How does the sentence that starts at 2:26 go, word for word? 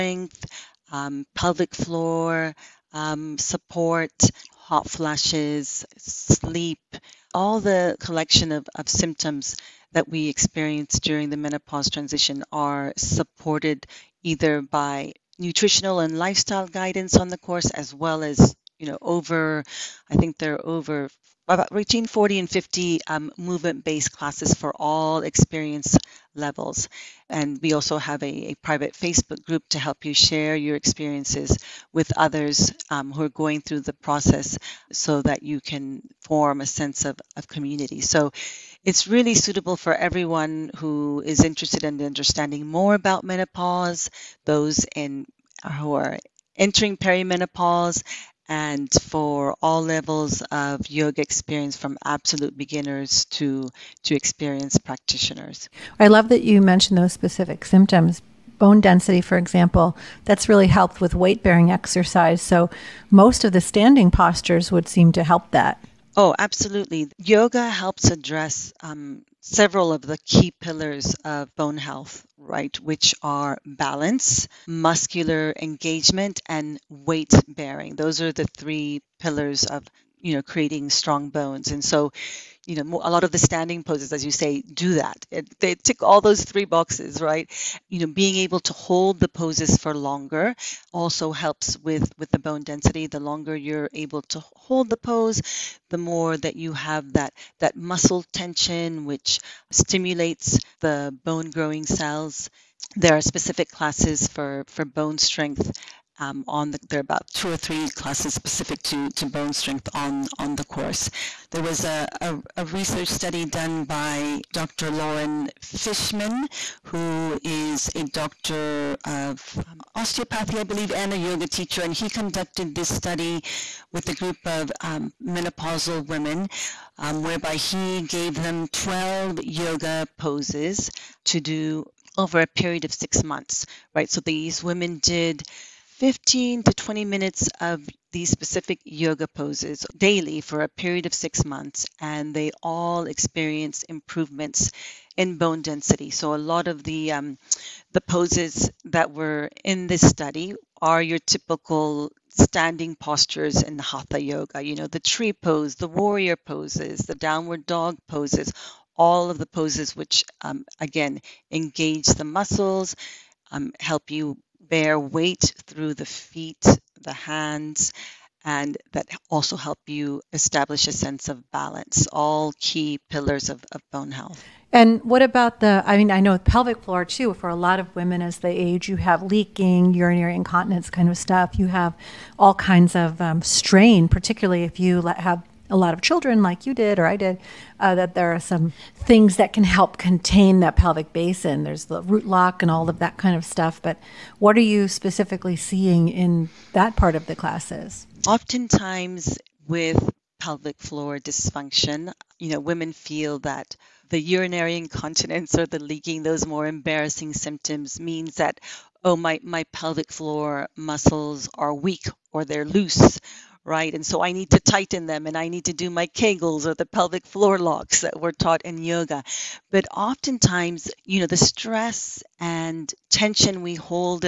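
So a lot of the um, the poses that were in this study are your typical standing postures in hatha yoga.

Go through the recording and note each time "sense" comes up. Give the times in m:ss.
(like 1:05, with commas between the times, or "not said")
0:36, 2:50.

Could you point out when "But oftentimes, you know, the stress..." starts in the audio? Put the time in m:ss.
3:39.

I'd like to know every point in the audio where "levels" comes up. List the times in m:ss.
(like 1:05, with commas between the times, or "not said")
0:26, 0:49.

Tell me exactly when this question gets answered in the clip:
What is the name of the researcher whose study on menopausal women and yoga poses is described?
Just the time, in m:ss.
1:54.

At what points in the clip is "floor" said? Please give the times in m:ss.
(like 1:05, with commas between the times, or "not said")
0:01, 2:56, 3:20, 3:30, 3:37.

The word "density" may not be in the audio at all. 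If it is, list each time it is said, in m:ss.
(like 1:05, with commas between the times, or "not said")
0:58, 1:32, 2:25.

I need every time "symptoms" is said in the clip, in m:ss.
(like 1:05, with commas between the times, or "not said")
0:08, 0:57, 3:27.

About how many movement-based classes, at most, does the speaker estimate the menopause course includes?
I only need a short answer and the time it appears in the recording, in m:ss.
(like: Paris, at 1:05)
50, at 0:21.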